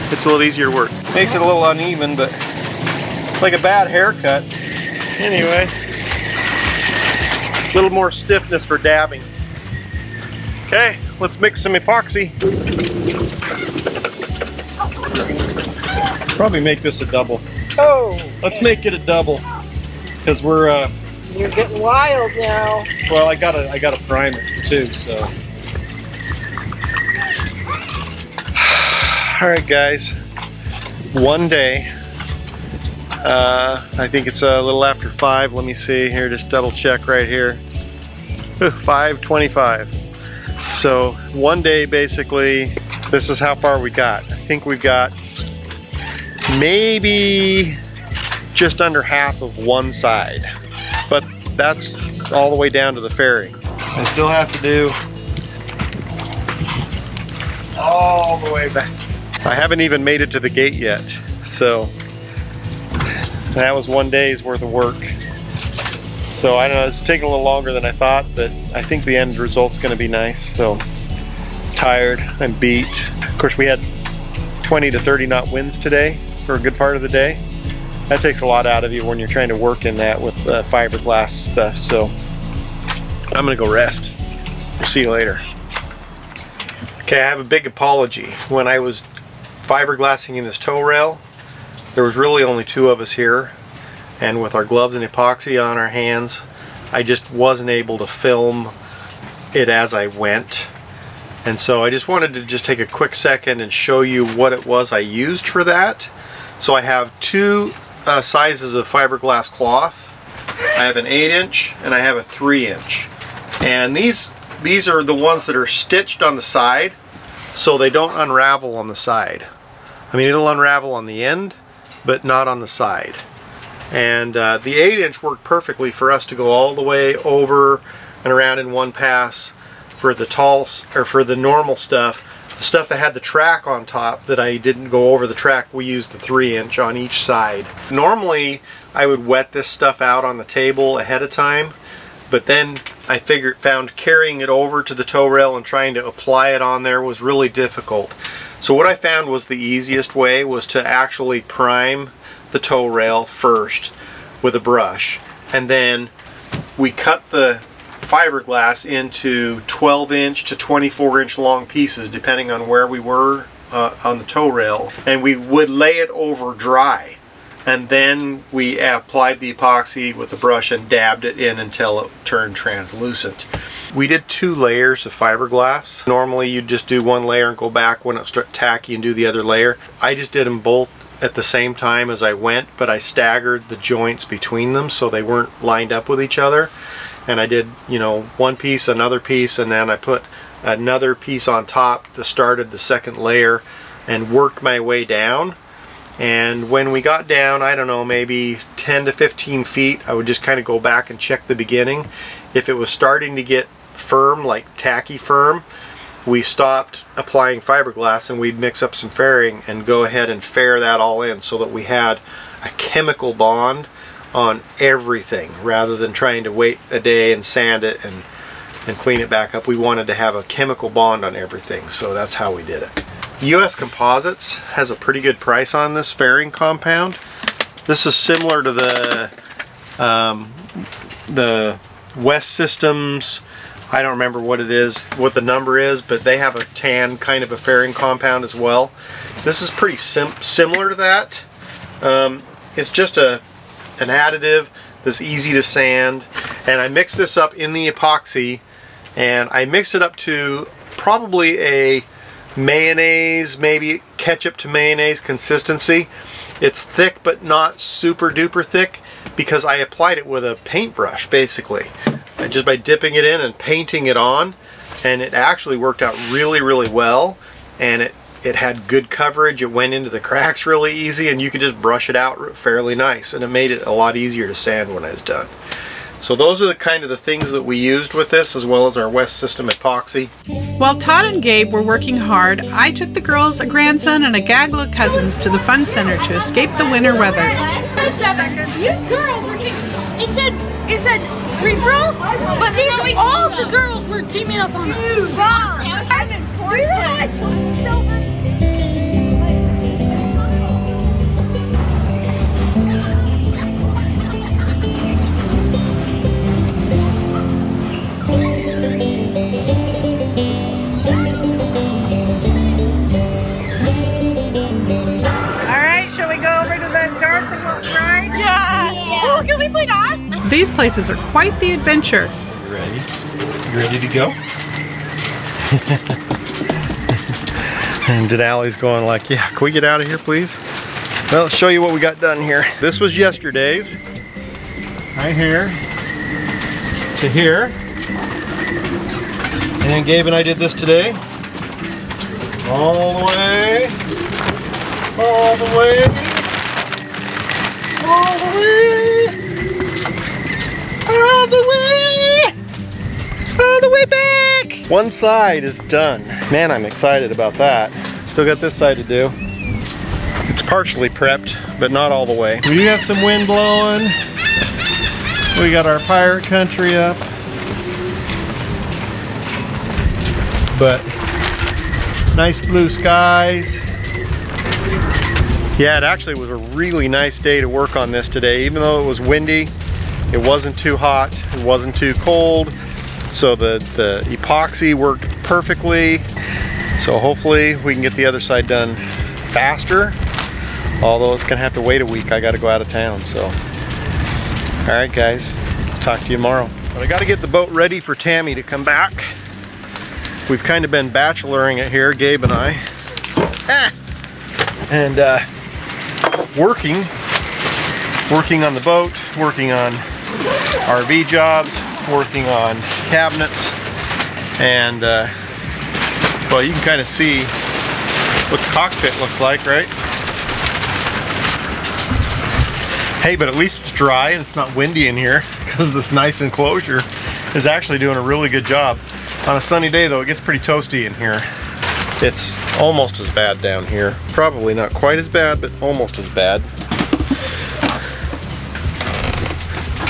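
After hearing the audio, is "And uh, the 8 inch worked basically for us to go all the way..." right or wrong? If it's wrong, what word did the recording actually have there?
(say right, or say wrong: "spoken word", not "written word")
wrong: "perfectly", not "basically".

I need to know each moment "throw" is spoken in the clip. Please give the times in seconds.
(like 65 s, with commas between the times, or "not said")
291 s.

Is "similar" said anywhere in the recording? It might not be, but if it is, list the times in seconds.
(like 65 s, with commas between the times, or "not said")
228 s, 240 s.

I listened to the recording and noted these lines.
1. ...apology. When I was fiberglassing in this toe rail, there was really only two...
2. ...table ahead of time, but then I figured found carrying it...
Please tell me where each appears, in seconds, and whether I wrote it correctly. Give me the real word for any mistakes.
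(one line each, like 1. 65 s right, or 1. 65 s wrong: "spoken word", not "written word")
1. 87 s right
2. 140 s right.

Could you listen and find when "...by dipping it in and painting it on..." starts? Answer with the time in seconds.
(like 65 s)
262 s.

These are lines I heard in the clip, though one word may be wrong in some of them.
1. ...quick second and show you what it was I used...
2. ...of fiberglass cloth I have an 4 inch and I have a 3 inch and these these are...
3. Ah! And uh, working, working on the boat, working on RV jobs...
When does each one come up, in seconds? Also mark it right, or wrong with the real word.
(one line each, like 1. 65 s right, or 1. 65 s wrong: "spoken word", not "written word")
1. 102 s right
2. 108 s wrong: "8", not "4"
3. 403 s right.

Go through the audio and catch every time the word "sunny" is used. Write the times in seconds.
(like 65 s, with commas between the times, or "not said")
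429 s.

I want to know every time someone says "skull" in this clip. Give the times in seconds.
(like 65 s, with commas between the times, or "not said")
not said.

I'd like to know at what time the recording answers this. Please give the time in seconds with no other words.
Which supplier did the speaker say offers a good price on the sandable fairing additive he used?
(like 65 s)
223 s.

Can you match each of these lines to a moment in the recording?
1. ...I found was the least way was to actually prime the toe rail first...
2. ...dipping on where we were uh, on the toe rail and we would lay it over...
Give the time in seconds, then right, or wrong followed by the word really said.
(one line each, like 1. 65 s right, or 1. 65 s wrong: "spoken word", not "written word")
1. 148 s wrong: "easiest", not "least"
2. 162 s wrong: "depending", not "dipping".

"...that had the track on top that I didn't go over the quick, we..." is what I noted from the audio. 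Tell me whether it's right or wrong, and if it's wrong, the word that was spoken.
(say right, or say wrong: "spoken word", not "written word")
wrong: "track", not "quick".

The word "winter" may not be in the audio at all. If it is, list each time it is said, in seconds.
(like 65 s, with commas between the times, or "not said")
286 s.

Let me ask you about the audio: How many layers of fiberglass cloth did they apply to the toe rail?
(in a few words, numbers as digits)
2.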